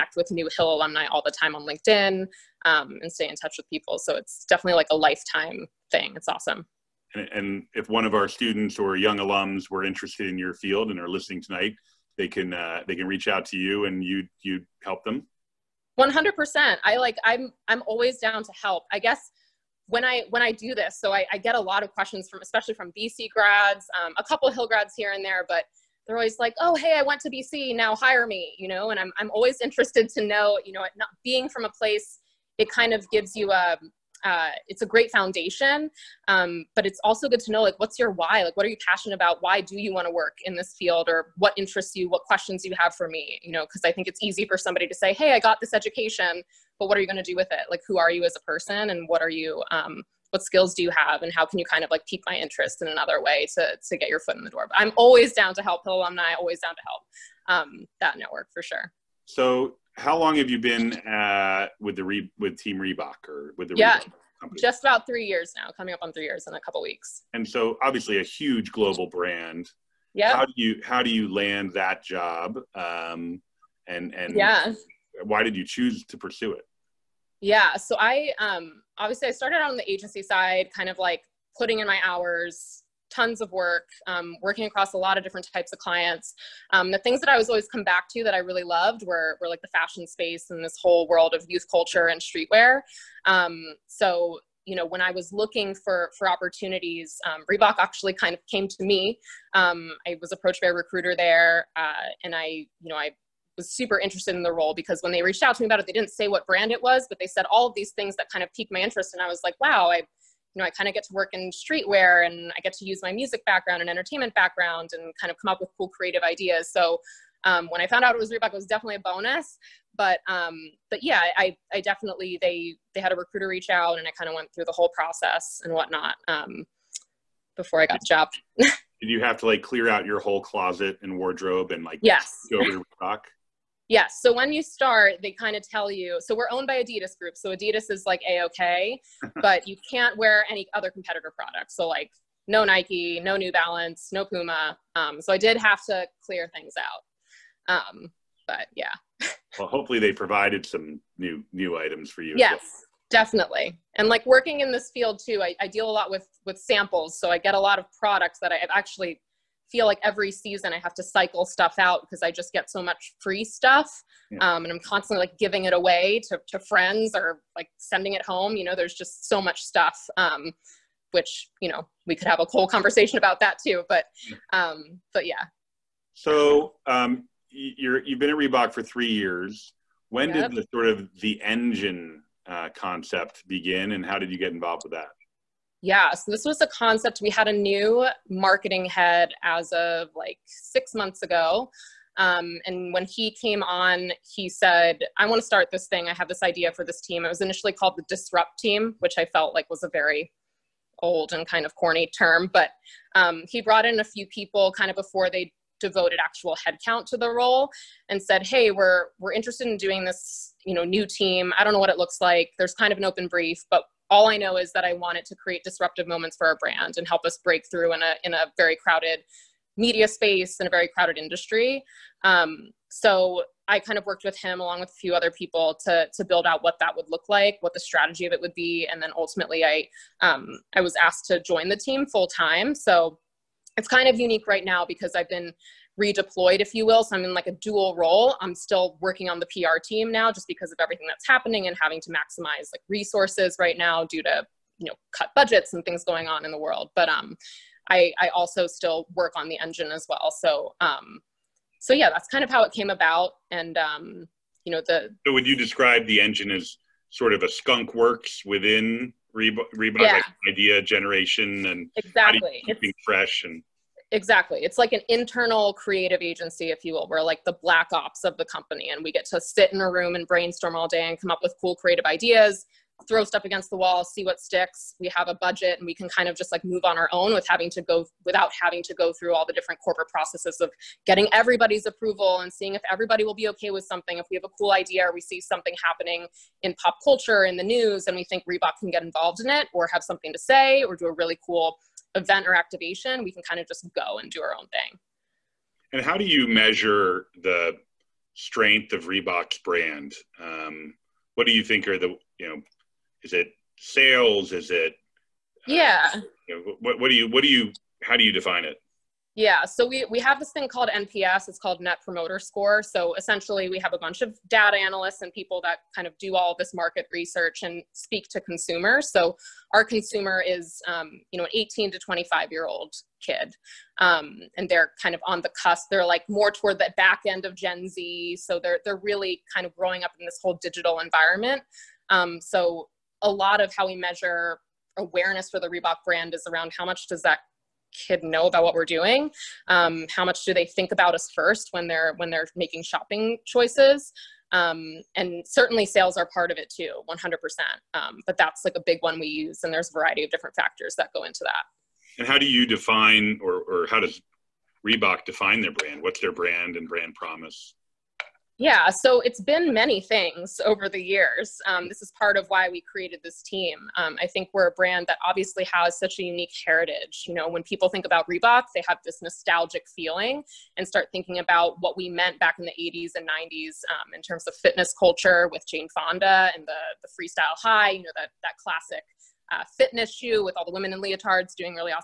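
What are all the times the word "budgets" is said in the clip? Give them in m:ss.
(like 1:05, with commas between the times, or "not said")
4:05, 4:35.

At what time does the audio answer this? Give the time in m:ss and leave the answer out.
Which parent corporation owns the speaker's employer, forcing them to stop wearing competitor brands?
2:16.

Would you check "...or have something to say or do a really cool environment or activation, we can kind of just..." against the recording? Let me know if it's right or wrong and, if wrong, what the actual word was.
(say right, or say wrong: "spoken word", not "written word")
wrong: "event", not "environment".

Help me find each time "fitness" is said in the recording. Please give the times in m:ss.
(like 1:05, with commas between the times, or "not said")
6:14, 6:19.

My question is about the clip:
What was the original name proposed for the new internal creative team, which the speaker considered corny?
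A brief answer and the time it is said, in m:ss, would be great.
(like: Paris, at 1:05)
the disrupt team, at 3:17.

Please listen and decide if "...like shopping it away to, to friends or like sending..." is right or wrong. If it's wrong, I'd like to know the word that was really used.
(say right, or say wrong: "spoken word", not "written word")
wrong: "giving", not "shopping".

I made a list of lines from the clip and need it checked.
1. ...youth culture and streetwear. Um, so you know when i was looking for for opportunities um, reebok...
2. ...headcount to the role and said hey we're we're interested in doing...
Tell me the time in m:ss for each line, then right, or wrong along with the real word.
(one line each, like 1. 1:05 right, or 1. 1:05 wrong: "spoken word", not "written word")
1. 1:31 right
2. 3:26 right.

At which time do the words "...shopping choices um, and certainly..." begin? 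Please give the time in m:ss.
5:42.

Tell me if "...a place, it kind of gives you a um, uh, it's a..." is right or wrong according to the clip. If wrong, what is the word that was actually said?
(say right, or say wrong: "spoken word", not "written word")
right.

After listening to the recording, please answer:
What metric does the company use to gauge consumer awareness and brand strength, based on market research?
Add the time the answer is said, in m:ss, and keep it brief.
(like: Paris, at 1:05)
Net Promoter Score, at 5:11.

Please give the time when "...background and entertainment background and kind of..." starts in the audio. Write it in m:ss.
1:53.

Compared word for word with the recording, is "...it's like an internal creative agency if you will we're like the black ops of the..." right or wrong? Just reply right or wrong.
right.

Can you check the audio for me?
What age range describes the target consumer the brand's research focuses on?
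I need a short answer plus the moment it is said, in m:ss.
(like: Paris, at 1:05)
18 to 25, at 5:21.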